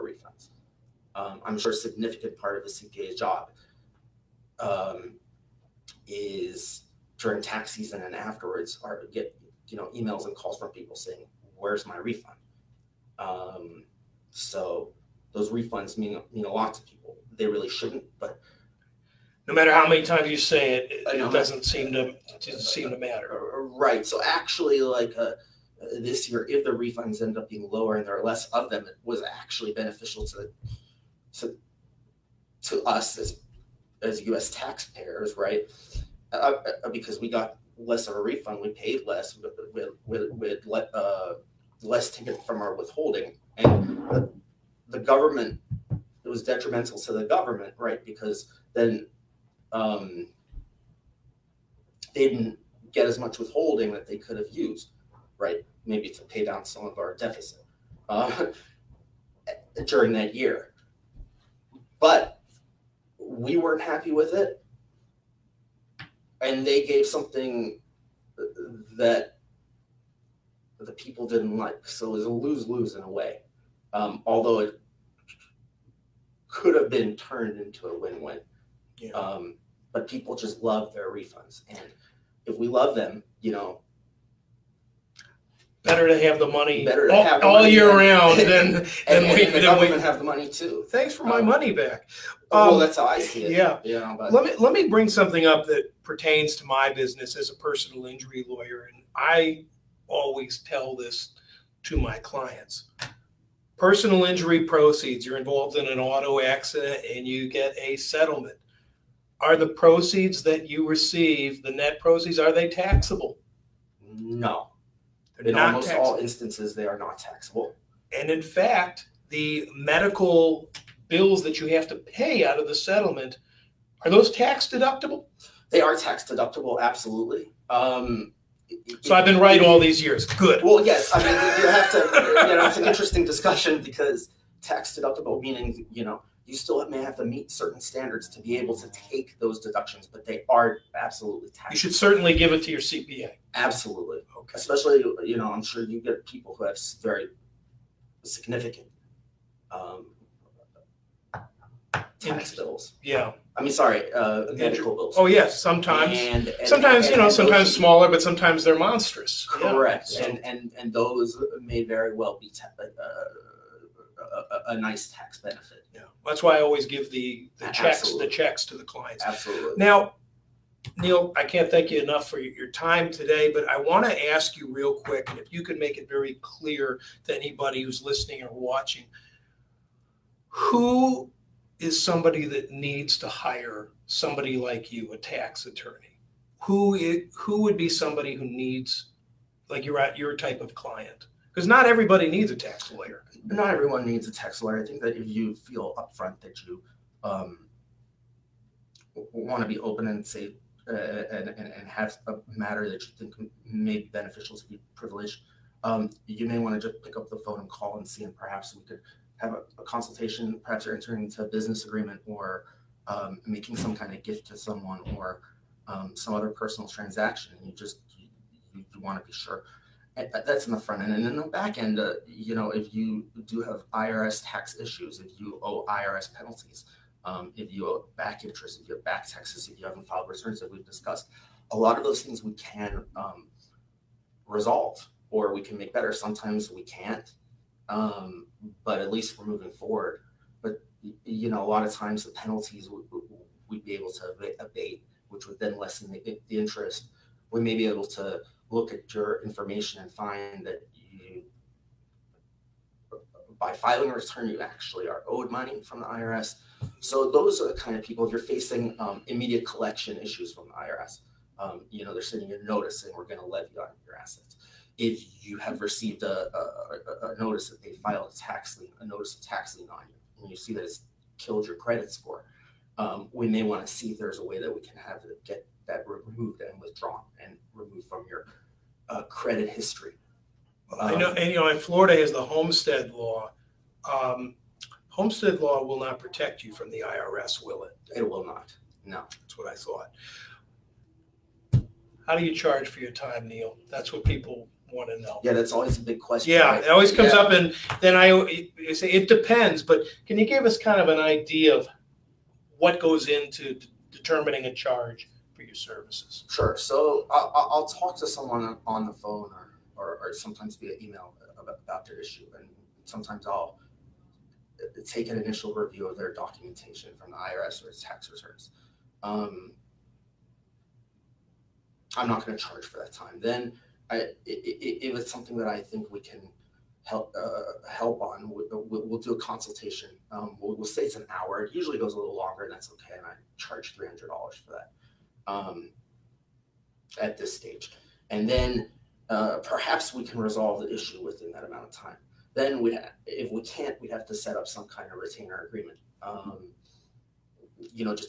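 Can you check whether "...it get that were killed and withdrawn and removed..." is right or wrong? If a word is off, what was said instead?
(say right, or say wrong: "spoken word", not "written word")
wrong: "removed", not "killed".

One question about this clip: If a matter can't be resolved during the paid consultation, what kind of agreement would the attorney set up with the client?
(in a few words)
Retainer agreement.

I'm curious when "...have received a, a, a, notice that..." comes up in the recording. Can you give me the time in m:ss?
4:25.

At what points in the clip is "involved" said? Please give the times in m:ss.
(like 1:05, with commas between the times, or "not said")
1:45.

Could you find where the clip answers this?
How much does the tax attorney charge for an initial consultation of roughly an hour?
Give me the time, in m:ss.
5:33.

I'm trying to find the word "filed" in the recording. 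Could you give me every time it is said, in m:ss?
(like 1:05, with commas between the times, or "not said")
3:50, 4:28.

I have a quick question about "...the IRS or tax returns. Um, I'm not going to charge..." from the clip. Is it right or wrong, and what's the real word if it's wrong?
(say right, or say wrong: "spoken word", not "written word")
right.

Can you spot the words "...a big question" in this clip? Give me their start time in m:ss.
4:55.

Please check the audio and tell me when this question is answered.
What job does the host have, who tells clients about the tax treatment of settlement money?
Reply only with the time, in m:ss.
1:37.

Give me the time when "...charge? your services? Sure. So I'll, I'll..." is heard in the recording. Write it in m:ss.
5:04.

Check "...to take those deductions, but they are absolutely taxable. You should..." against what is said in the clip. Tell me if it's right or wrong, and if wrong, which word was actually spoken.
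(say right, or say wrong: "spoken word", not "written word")
right.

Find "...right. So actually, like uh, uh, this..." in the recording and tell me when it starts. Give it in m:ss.
0:23.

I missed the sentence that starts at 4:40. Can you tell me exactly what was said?
Um, I know, and you know, Florida has the homestead law.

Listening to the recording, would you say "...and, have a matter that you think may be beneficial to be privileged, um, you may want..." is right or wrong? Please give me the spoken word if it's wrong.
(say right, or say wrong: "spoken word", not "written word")
right.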